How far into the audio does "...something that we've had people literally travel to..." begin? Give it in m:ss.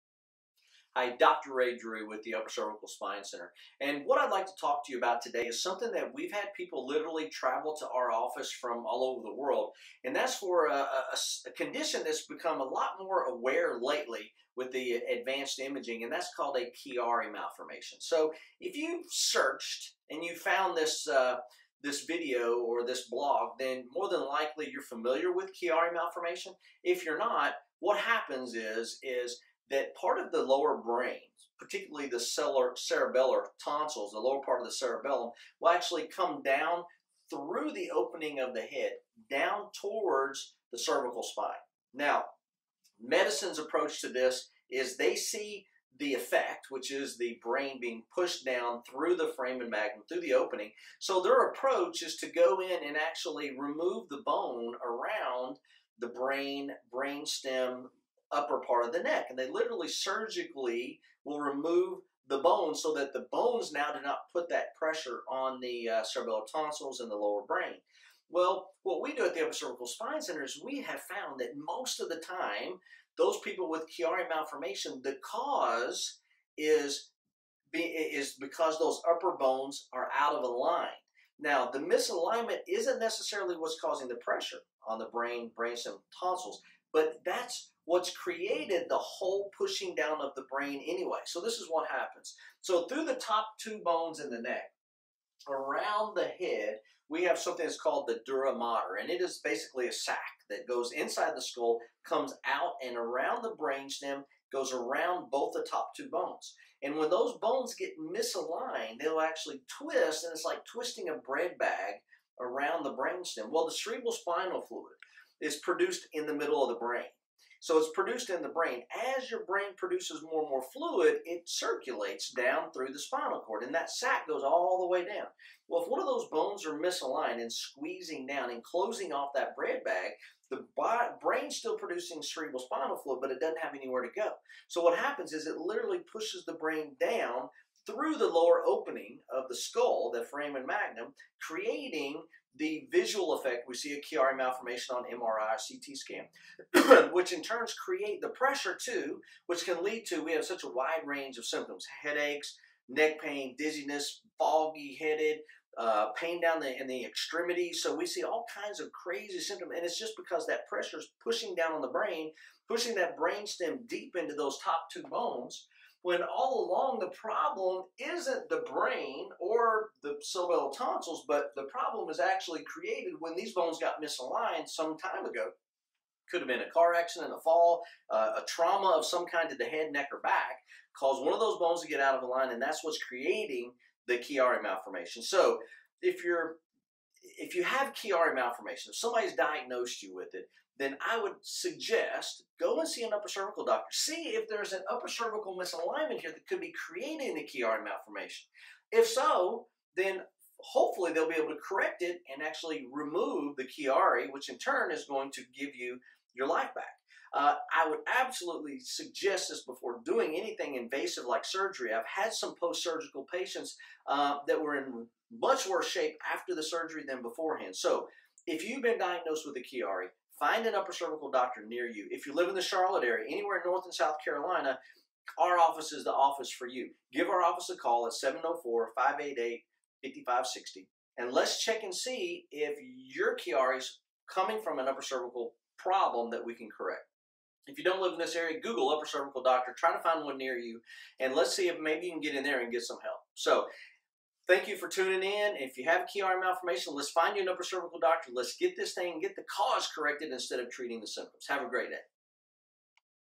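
0:05.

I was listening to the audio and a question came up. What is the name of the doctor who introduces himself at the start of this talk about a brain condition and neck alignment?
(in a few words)
Ray Drury.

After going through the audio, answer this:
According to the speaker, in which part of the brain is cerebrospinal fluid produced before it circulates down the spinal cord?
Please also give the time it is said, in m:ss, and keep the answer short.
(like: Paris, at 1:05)
middle of the brain, at 1:56.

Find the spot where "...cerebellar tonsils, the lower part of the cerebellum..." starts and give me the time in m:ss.
0:32.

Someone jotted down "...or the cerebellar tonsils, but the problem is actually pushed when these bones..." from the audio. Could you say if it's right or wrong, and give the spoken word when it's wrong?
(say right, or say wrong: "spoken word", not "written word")
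wrong: "created", not "pushed".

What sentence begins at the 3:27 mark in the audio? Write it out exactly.
Uh, I would absolutely suggest this before doing anything invasive like surgery.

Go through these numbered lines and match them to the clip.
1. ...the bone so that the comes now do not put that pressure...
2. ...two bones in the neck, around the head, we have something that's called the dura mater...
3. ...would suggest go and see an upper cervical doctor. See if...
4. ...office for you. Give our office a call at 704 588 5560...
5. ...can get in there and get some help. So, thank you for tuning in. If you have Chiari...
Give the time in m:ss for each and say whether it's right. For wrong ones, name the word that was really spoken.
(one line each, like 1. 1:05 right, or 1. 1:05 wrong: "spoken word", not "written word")
1. 1:02 wrong: "bones", not "comes"
2. 1:33 right
3. 3:11 right
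4. 3:46 right
5. 4:02 right.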